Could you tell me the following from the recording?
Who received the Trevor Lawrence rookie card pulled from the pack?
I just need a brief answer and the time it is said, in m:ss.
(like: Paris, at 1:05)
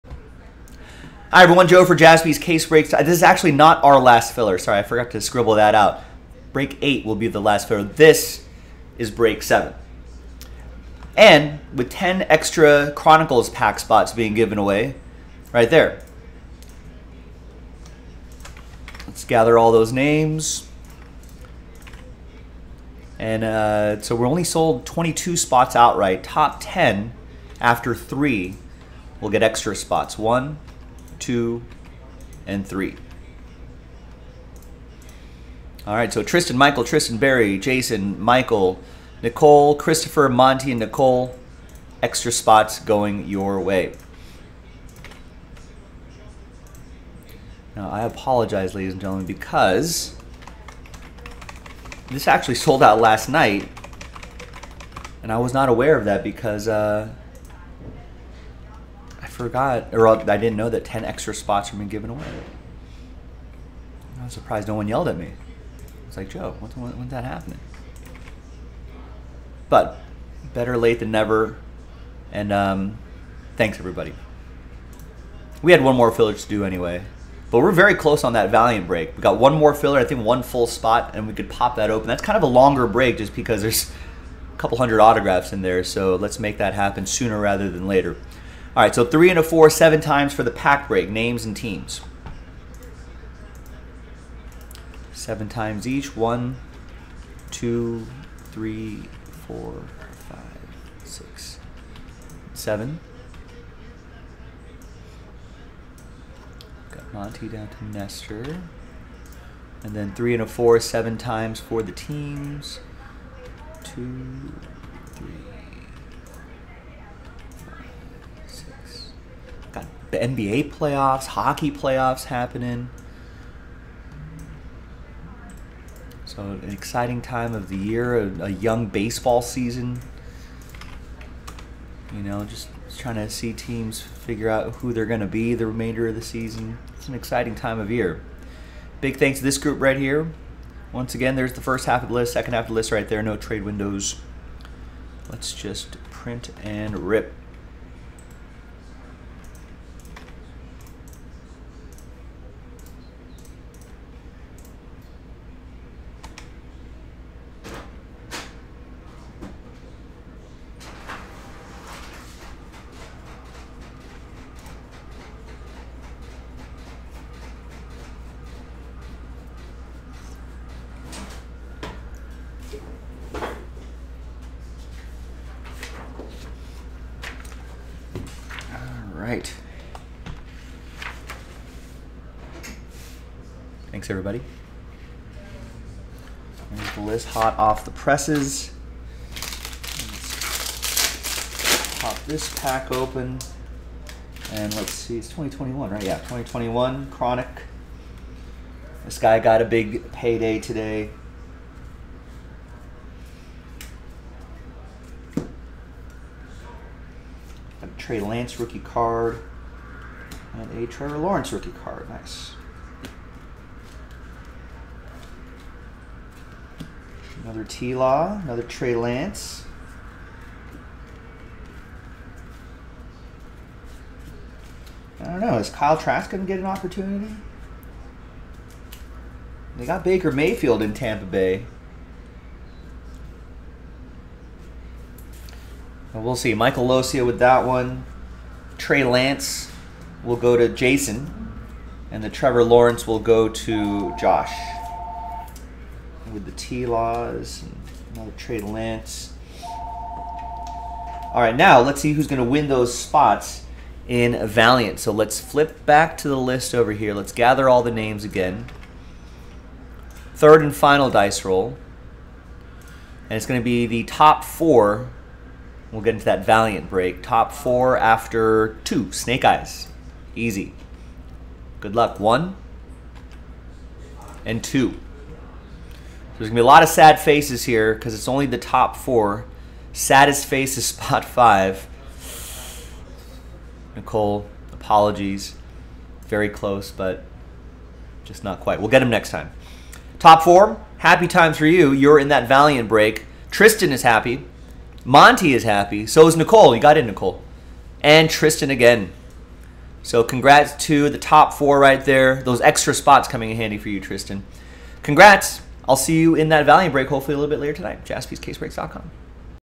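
Josh, at 4:04.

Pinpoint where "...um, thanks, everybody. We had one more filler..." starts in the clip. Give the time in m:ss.
1:12.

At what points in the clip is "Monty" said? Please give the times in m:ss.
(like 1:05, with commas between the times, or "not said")
0:40, 1:47, 4:55.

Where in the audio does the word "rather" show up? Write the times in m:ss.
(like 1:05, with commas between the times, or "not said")
1:27.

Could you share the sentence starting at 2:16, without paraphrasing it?
It's an exciting time of year.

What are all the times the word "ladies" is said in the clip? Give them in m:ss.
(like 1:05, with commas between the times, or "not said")
0:48.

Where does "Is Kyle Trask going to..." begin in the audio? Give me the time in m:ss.
3:45.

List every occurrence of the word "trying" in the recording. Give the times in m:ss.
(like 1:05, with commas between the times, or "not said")
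2:12.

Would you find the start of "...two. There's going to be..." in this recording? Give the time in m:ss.
4:34.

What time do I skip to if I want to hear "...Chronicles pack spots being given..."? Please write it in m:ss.
0:12.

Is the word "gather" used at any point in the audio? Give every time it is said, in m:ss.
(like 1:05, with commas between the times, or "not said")
0:19, 4:17.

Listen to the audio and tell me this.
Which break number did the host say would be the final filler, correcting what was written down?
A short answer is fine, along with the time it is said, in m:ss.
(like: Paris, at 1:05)
Break 8, at 0:06.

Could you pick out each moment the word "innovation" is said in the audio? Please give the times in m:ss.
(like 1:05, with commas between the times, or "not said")
not said.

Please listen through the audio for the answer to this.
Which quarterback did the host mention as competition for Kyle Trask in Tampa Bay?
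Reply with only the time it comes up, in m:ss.
3:50.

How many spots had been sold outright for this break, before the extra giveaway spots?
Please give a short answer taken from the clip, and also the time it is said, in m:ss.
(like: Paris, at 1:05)
22, at 0:24.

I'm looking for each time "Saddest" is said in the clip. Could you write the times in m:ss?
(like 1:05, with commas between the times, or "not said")
4:39.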